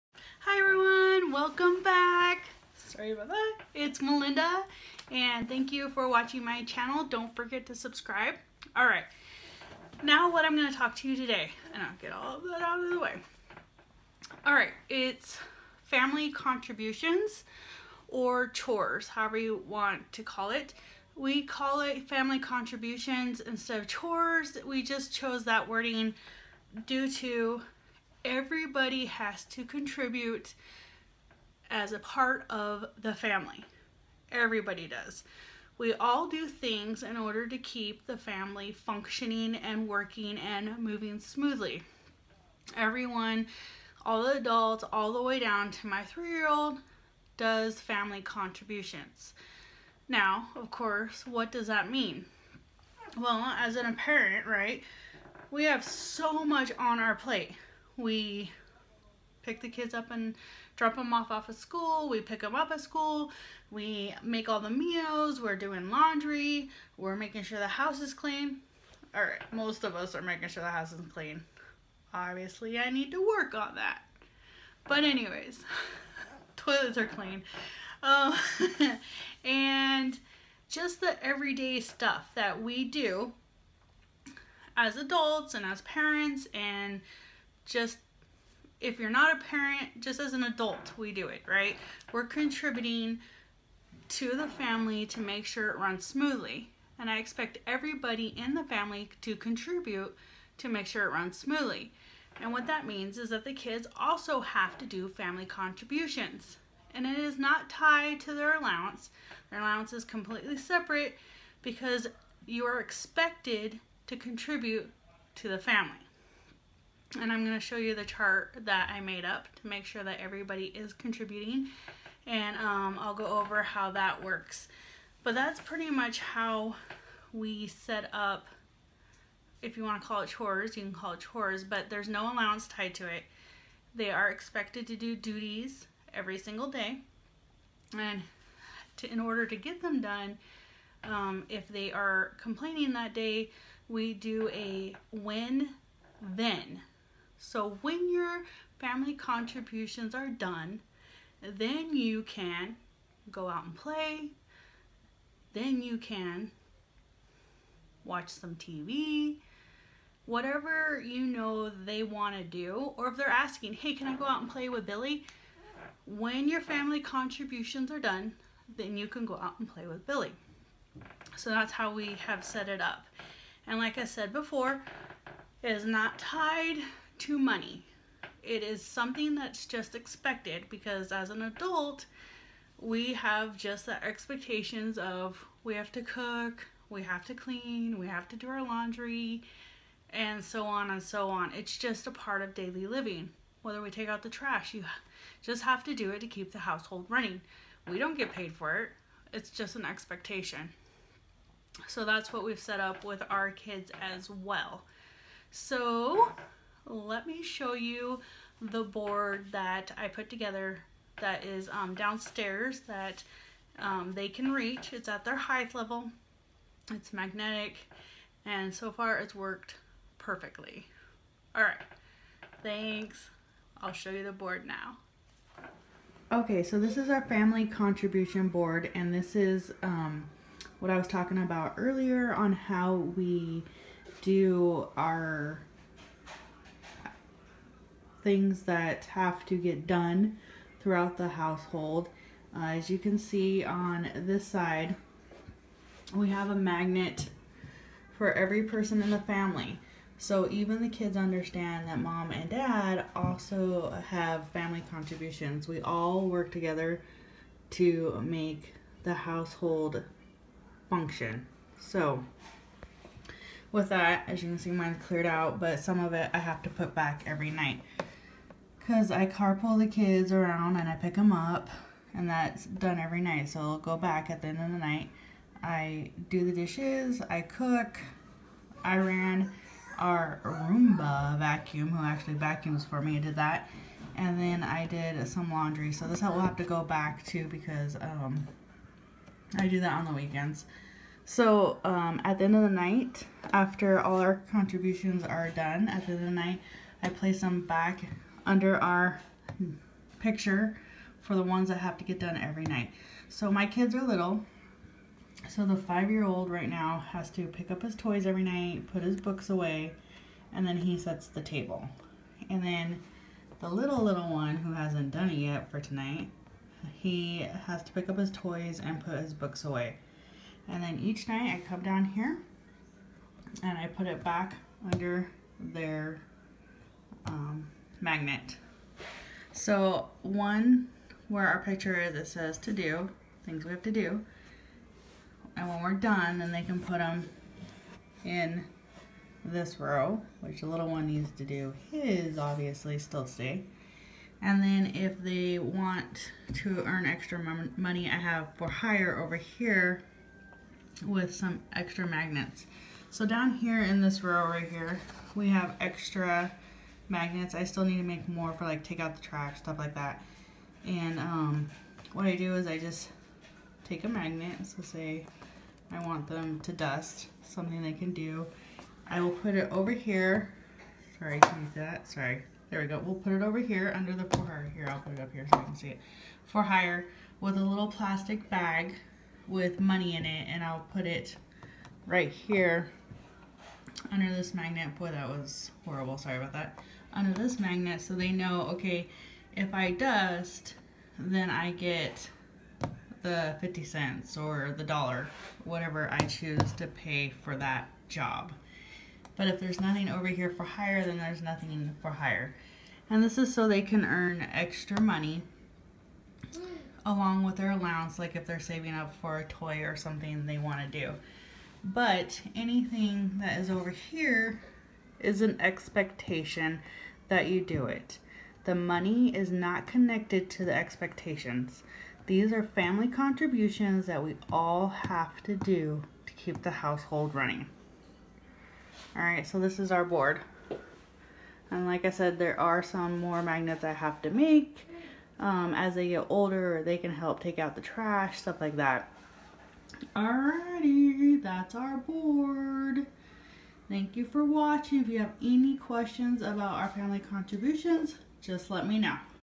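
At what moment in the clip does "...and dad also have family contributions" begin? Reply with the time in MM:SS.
04:12.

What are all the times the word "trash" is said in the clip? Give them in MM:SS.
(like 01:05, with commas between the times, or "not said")
03:14, 05:59, 07:17.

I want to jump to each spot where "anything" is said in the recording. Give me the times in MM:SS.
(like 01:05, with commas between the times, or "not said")
06:52.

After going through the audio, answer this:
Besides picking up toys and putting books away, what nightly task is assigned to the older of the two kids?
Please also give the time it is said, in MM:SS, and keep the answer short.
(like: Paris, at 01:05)
Sets the table, at 05:10.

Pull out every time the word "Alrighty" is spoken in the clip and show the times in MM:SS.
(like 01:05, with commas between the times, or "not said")
07:20.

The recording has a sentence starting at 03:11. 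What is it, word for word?
It's just a part of daily living.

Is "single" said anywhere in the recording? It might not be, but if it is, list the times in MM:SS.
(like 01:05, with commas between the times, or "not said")
02:16.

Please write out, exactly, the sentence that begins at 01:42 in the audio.
And what that means is that the kids also have to do family contributions.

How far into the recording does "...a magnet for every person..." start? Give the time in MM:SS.
04:06.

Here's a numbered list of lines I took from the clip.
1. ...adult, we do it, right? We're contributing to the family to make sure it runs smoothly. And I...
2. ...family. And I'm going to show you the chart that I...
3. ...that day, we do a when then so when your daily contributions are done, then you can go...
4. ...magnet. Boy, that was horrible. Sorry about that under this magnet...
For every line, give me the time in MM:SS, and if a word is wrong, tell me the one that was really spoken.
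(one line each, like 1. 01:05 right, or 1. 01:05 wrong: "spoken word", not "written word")
1. 01:30 right
2. 01:55 right
3. 02:22 wrong: "family", not "daily"
4. 06:24 right.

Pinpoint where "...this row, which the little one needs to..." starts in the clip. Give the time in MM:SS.
05:39.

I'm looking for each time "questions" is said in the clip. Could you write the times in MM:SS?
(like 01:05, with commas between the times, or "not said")
07:25.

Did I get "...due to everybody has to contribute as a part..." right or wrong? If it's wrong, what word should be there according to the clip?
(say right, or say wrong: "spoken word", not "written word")
right.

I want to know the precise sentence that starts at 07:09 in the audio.
All right, so this is our board.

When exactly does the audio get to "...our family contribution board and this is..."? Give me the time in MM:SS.
03:47.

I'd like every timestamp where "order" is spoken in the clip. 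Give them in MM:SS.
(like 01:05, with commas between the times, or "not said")
00:37, 02:19.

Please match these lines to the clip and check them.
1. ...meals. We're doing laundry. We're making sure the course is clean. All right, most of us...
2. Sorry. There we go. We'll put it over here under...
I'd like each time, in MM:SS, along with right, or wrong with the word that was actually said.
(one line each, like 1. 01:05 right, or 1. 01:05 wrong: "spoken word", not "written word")
1. 01:04 wrong: "house", not "course"
2. 06:12 right.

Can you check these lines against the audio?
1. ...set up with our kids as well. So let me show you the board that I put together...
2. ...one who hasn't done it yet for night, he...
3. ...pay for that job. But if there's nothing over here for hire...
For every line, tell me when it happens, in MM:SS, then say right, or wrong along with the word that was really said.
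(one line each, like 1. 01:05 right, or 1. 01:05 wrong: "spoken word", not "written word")
1. 03:22 right
2. 05:14 wrong: "tonight", not "night"
3. 06:36 right.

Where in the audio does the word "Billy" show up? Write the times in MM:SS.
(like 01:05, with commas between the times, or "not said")
02:44, 02:50.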